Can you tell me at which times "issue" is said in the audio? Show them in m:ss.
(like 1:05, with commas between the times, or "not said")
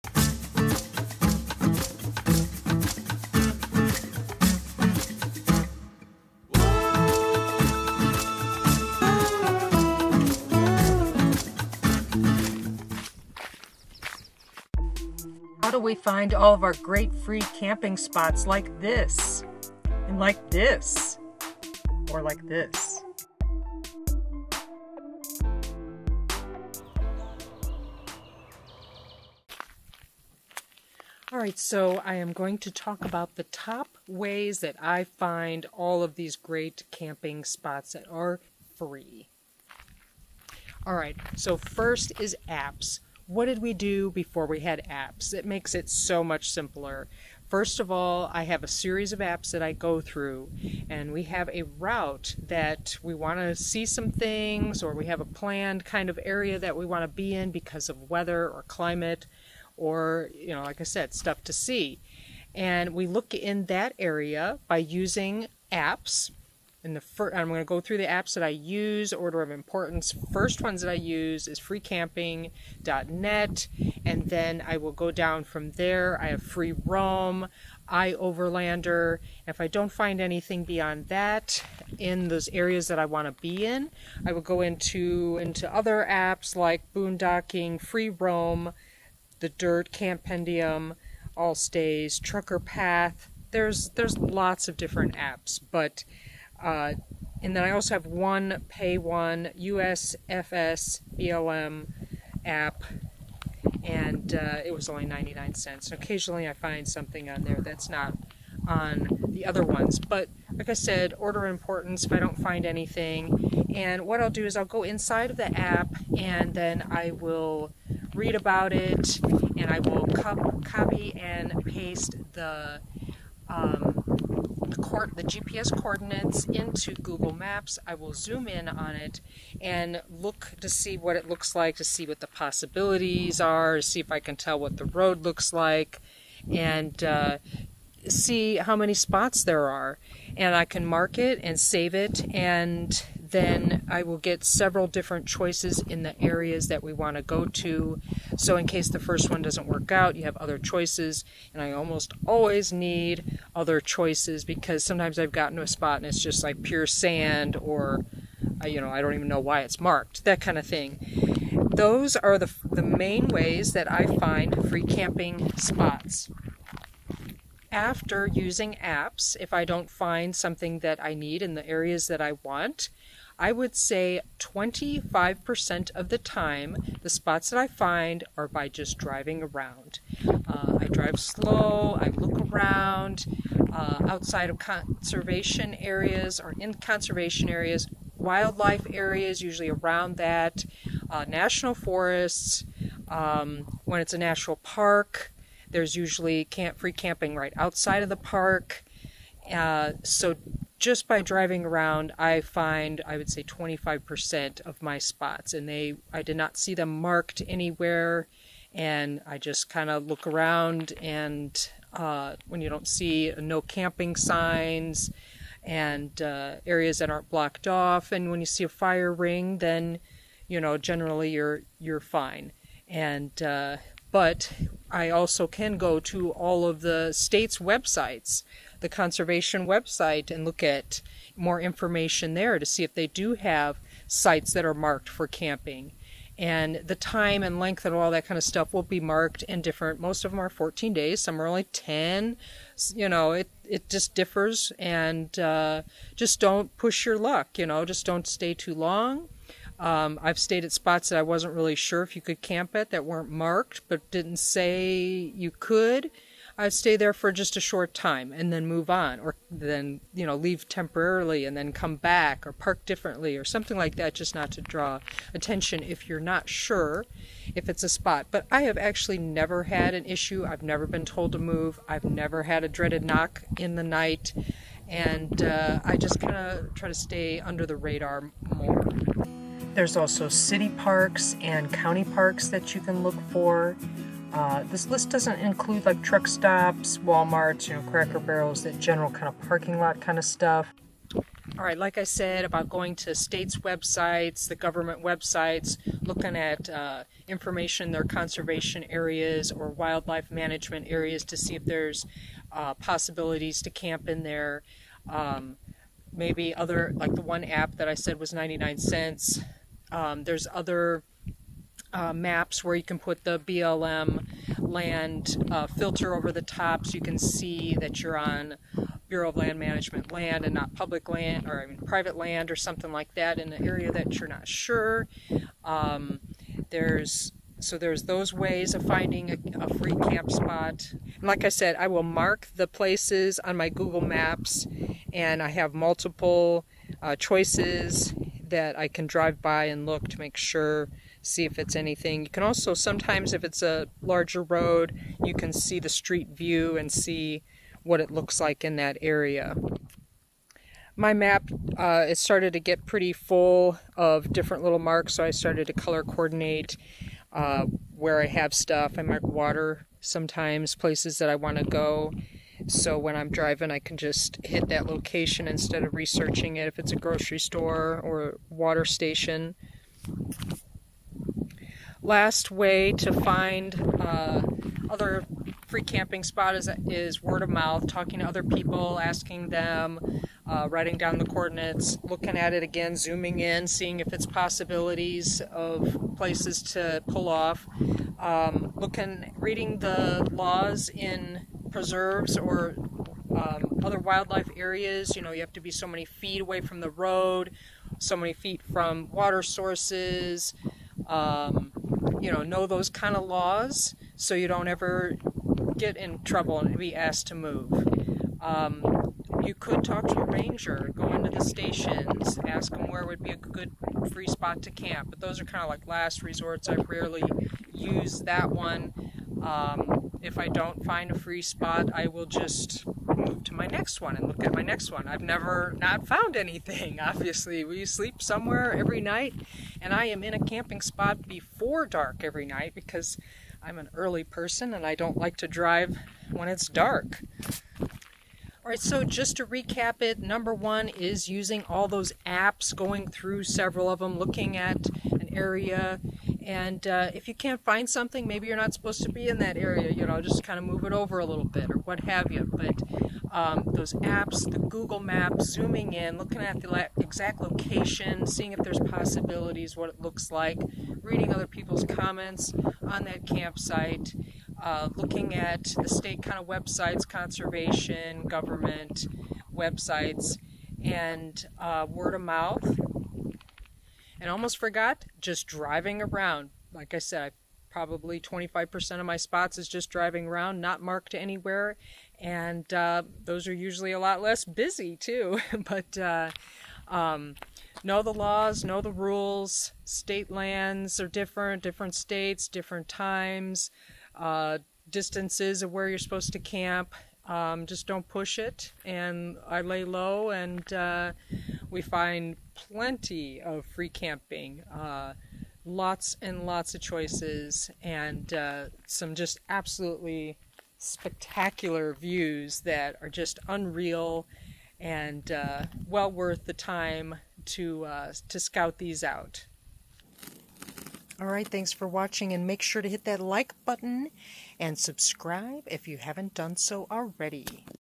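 4:30.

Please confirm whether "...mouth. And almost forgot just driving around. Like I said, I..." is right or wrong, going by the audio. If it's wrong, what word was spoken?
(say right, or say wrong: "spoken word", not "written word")
right.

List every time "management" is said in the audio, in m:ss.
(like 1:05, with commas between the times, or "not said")
5:00, 5:19.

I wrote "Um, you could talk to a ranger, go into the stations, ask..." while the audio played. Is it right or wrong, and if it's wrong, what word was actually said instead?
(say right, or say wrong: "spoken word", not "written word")
right.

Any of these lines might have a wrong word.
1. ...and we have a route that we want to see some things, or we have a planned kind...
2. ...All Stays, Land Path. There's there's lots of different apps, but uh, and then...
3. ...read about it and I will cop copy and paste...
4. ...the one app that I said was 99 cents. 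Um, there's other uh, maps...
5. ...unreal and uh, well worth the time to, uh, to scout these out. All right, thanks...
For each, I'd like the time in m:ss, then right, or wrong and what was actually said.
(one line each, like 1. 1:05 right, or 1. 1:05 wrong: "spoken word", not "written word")
1. 0:50 right
2. 1:31 wrong: "Trucker", not "Land"
3. 1:58 right
4. 5:07 right
5. 8:33 right.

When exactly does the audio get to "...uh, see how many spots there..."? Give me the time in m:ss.
2:17.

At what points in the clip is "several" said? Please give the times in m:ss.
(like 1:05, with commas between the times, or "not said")
2:24, 7:23.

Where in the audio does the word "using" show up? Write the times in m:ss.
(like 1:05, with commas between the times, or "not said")
1:04, 2:48, 7:21.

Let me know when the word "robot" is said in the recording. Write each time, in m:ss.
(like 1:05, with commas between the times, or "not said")
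not said.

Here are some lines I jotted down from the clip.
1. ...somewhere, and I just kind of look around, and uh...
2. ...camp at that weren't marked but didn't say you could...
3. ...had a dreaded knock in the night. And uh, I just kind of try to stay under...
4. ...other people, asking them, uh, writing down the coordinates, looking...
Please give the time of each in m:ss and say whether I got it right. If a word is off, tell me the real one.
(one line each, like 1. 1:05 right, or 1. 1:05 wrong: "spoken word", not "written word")
1. 3:27 wrong: "anywhere", not "somewhere"
2. 4:12 right
3. 4:32 right
4. 6:18 right.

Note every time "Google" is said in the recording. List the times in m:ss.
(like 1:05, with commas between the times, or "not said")
2:06, 5:33, 7:34.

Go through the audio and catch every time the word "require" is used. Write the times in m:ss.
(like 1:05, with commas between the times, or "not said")
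not said.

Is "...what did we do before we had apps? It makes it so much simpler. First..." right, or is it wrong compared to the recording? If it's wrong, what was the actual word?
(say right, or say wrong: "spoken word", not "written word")
right.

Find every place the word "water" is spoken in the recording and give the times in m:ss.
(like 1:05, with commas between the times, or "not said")
5:59, 6:08, 6:39.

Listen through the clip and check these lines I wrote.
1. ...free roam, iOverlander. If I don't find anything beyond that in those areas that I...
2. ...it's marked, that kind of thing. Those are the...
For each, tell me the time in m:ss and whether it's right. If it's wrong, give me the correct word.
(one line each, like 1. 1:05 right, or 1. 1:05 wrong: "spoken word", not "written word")
1. 1:16 right
2. 2:39 right.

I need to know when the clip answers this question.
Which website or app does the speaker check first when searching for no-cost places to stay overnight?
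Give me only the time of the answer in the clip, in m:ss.
1:11.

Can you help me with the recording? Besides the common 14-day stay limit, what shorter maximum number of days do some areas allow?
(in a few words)
10.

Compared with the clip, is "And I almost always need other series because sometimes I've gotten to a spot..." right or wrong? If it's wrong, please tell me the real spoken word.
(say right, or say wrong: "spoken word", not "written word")
wrong: "choices", not "series".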